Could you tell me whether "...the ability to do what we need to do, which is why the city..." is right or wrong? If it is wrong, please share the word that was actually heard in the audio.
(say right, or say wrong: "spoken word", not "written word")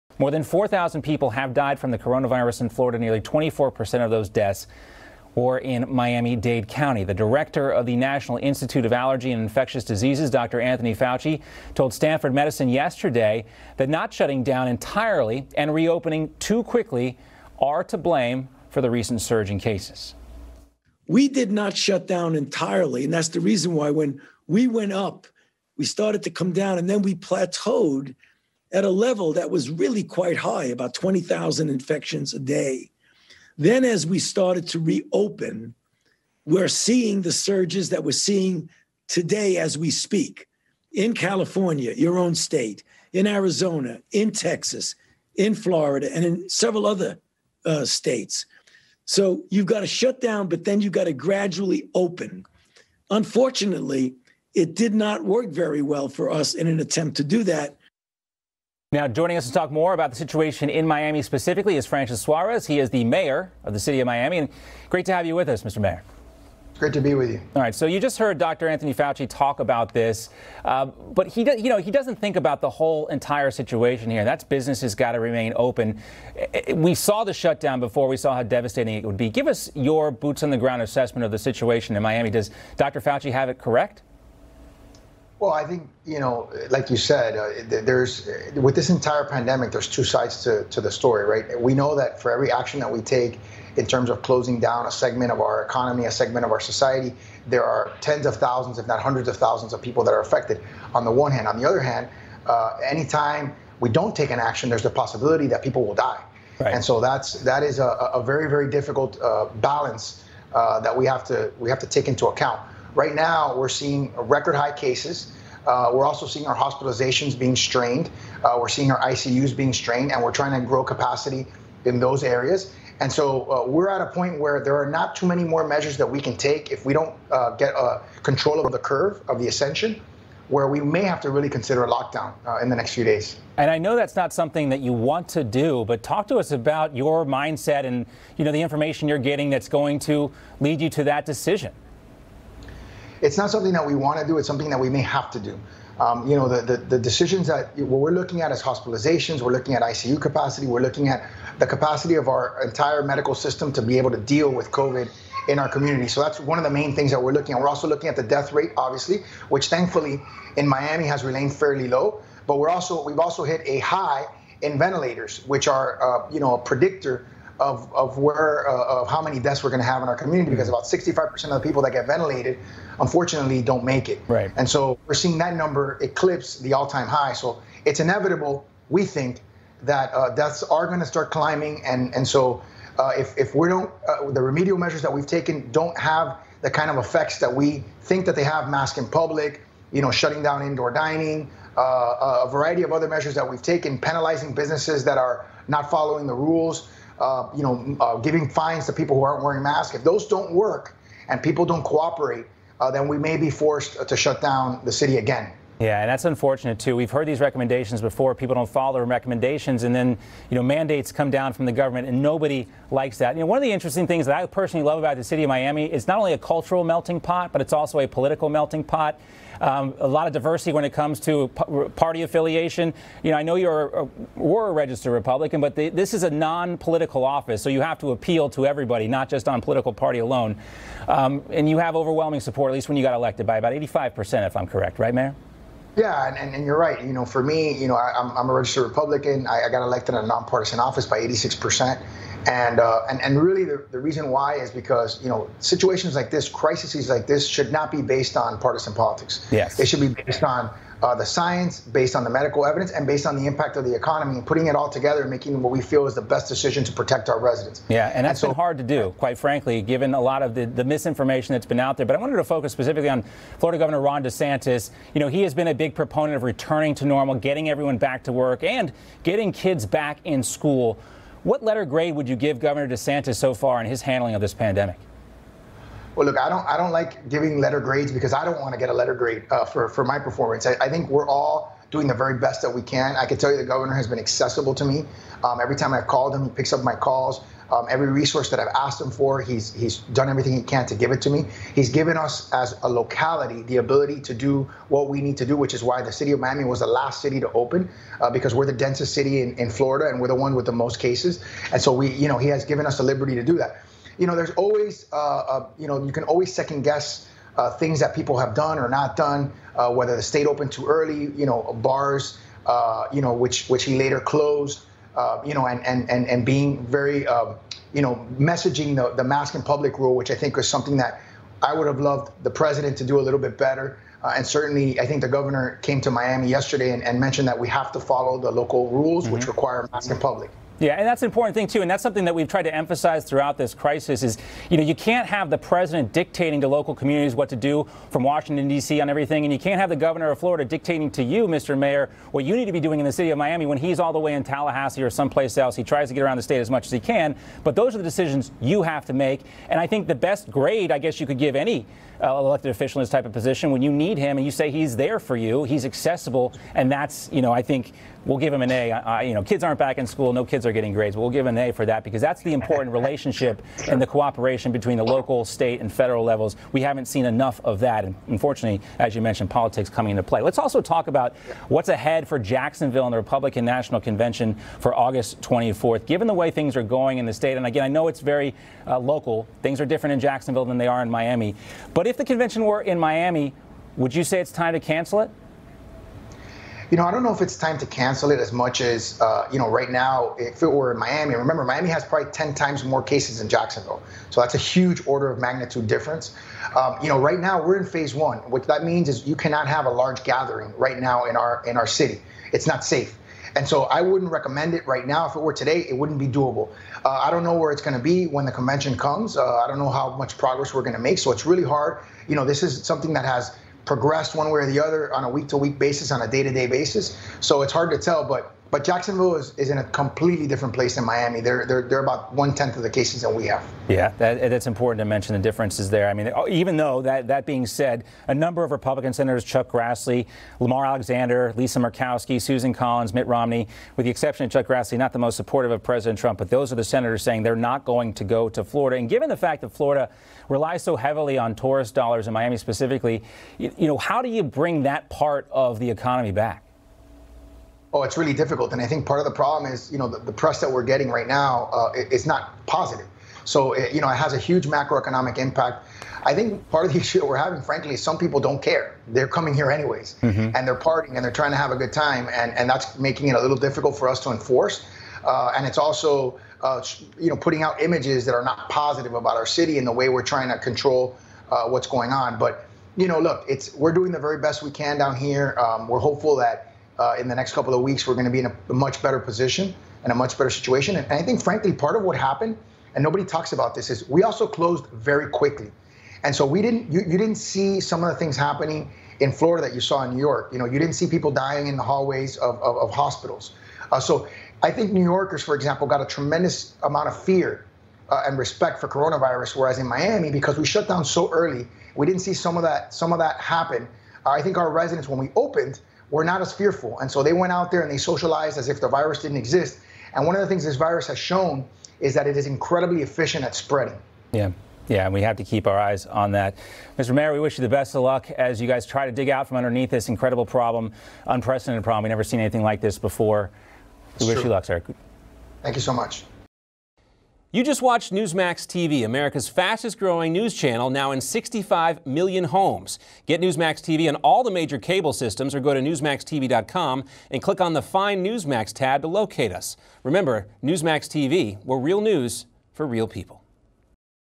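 right.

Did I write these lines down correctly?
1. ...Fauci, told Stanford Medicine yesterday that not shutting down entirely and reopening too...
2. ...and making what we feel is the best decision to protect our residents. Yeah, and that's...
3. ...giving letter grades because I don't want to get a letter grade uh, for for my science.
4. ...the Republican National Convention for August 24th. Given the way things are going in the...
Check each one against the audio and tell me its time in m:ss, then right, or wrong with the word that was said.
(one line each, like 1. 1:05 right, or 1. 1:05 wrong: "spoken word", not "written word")
1. 0:10 right
2. 4:15 right
3. 4:37 wrong: "performance", not "science"
4. 6:13 right.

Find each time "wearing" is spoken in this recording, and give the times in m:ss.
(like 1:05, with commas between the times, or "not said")
3:19.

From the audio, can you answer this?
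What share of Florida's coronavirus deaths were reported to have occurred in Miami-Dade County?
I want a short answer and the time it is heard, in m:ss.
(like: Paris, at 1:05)
Nearly 24%, at 0:02.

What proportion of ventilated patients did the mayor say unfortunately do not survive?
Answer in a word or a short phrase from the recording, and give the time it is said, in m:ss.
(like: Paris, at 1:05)
About 65%, at 2:50.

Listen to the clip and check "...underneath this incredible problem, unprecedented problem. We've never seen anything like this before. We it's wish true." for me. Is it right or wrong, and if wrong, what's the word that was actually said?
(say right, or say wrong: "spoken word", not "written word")
right.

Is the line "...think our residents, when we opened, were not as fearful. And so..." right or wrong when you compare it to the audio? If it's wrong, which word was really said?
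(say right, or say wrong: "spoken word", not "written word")
right.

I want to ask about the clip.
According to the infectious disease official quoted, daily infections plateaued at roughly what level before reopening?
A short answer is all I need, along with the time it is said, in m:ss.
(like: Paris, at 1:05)
20,000 a day, at 0:30.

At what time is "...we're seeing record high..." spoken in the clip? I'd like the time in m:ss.
1:53.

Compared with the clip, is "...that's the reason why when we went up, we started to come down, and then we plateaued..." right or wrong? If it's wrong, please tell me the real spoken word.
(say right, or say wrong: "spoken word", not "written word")
right.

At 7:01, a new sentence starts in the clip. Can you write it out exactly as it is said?
They're, they're, they're about one tenth of the cases that we have.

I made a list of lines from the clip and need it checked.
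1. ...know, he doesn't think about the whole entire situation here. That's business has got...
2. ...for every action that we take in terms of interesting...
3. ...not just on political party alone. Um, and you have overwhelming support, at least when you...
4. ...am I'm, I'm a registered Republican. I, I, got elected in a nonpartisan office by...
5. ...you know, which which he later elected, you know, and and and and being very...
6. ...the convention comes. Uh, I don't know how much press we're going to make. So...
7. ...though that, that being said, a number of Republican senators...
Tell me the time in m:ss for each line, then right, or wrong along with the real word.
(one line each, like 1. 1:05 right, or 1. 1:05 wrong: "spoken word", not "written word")
1. 1:11 right
2. 1:32 wrong: "closing", not "interesting"
3. 3:49 right
4. 3:58 right
5. 5:13 wrong: "closed", not "elected"
6. 6:48 wrong: "progress", not "press"
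7. 7:06 right.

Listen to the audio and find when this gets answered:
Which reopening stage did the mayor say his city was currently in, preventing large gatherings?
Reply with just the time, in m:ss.
6:37.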